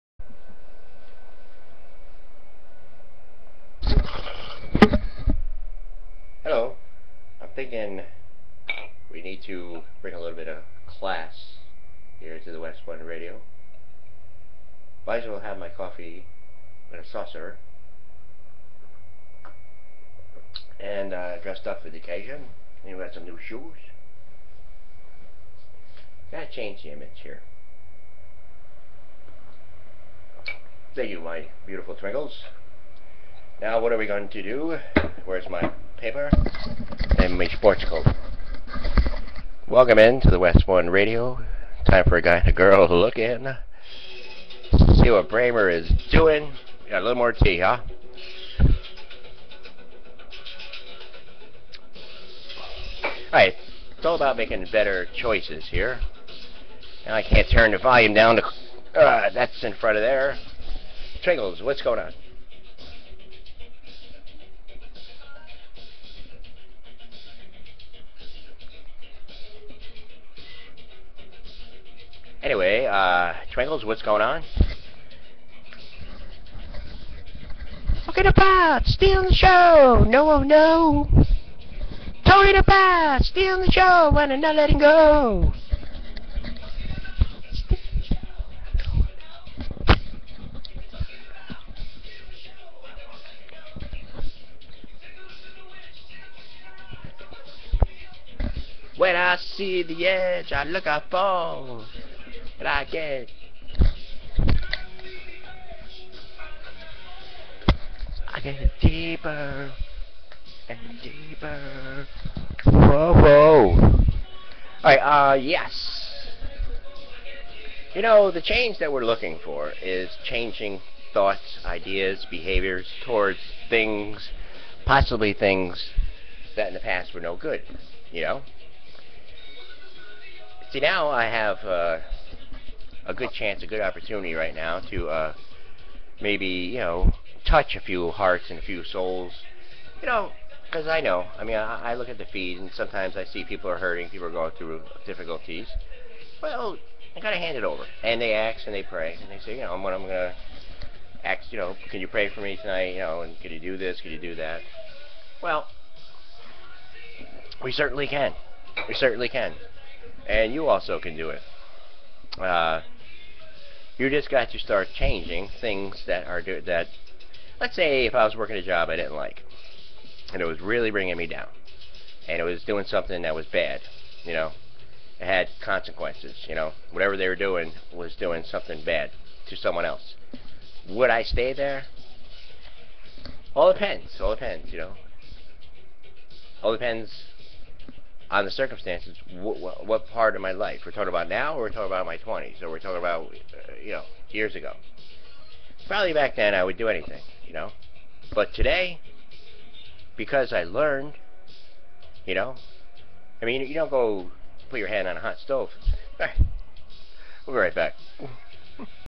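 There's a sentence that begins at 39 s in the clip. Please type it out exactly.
Welcome in to the Westbourne Radio.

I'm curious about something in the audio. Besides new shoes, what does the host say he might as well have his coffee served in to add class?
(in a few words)
A saucer.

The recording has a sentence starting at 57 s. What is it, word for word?
Now I can't turn the volume down to...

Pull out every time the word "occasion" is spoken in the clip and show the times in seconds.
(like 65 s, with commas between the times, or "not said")
21 s.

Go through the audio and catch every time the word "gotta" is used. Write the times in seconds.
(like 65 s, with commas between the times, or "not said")
26 s, 147 s.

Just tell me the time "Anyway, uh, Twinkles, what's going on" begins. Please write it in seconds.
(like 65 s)
72 s.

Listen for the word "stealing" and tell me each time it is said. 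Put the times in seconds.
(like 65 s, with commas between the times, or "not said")
78 s, 83 s.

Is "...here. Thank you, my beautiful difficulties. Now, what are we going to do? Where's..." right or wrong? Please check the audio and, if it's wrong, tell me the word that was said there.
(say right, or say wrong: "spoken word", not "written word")
wrong: "twinkles", not "difficulties".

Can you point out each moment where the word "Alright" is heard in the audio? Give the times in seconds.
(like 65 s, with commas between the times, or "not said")
53 s, 114 s.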